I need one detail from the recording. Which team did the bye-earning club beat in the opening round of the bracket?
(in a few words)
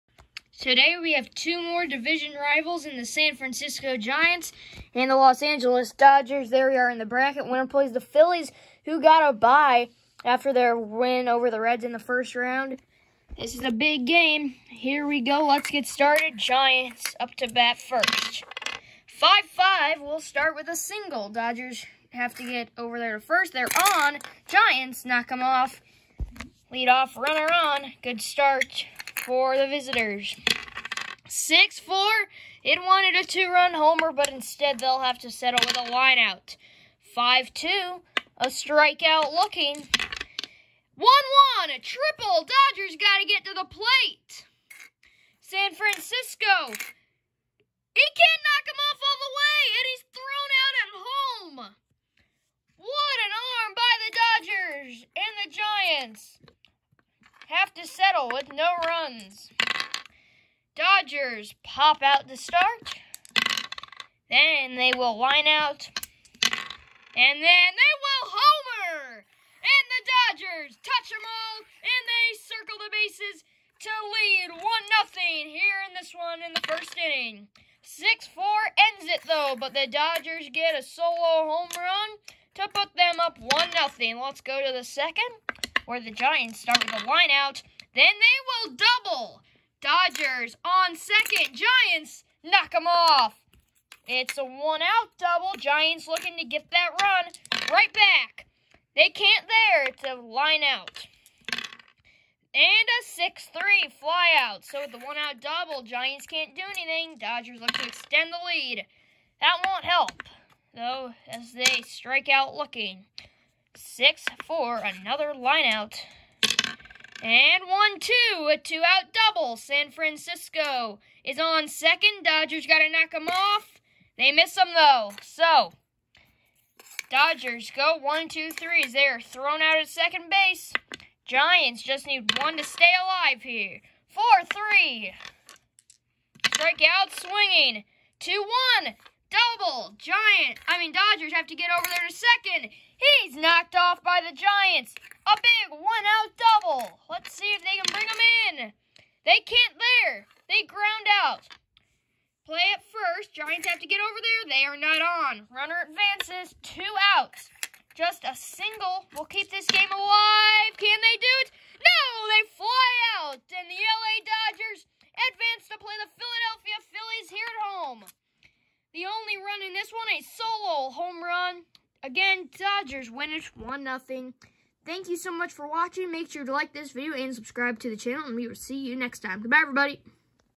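Reds.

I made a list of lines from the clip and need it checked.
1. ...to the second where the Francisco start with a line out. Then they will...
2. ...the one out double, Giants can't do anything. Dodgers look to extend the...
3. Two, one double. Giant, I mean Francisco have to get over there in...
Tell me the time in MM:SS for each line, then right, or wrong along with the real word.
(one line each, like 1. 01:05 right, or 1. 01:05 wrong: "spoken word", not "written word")
1. 01:24 wrong: "Giants", not "Francisco"
2. 01:44 right
3. 02:18 wrong: "Dodgers", not "Francisco".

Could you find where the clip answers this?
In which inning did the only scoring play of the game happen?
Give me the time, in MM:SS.
01:16.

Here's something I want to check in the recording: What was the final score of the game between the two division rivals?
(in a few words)
1-0.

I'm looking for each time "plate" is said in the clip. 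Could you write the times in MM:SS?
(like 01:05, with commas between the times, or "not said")
00:43.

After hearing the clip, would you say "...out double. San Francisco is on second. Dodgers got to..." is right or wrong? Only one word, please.
right.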